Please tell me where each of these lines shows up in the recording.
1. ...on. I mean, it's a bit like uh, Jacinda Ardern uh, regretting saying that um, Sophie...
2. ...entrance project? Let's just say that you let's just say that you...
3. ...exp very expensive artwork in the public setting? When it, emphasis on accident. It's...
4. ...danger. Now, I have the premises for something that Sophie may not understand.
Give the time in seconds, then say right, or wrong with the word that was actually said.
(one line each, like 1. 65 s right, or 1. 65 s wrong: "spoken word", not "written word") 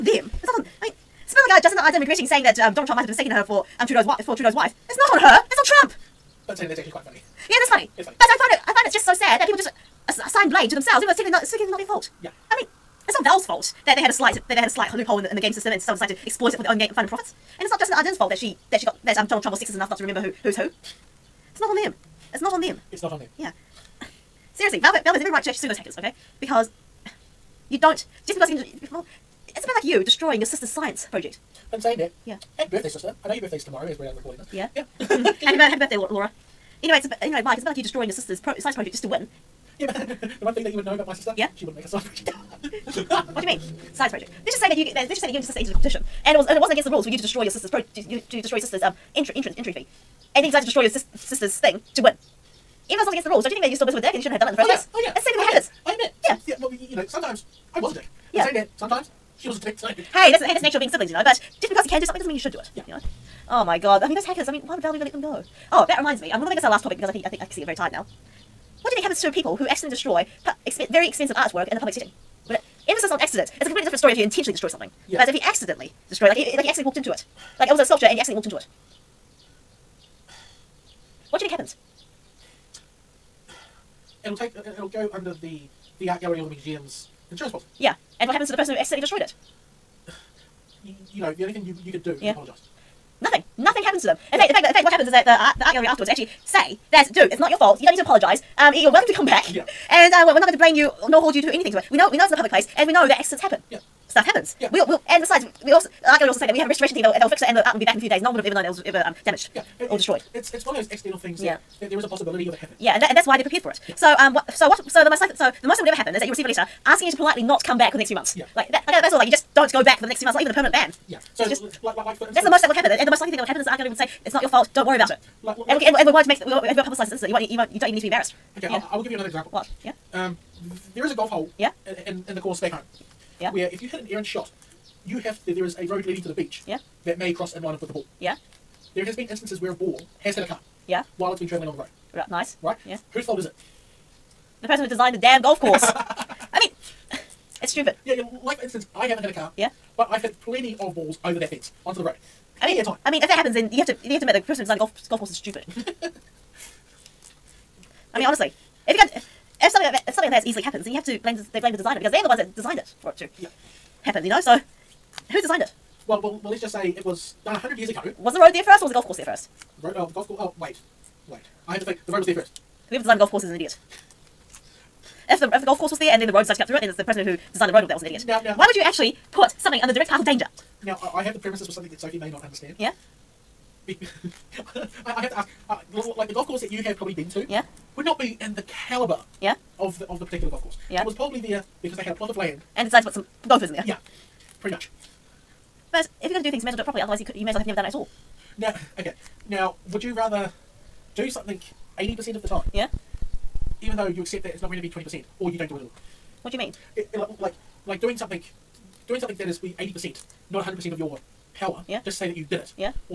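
1. 0 s wrong: "Donald", not "Sophie"
2. 43 s wrong: "science", not "entrance"
3. 70 s right
4. 180 s right.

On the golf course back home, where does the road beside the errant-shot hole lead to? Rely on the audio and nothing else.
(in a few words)
the beach.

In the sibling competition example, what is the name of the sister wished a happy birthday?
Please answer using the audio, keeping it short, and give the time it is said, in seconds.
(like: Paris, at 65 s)
Laura, at 35 s.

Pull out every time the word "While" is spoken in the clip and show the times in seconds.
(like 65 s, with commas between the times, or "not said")
141 s.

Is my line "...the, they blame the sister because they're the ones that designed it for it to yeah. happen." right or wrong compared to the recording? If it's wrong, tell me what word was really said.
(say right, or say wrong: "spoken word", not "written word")
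wrong: "designer", not "sister".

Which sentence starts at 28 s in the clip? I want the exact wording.
Well, it's a bit like you destroying your sister's science project.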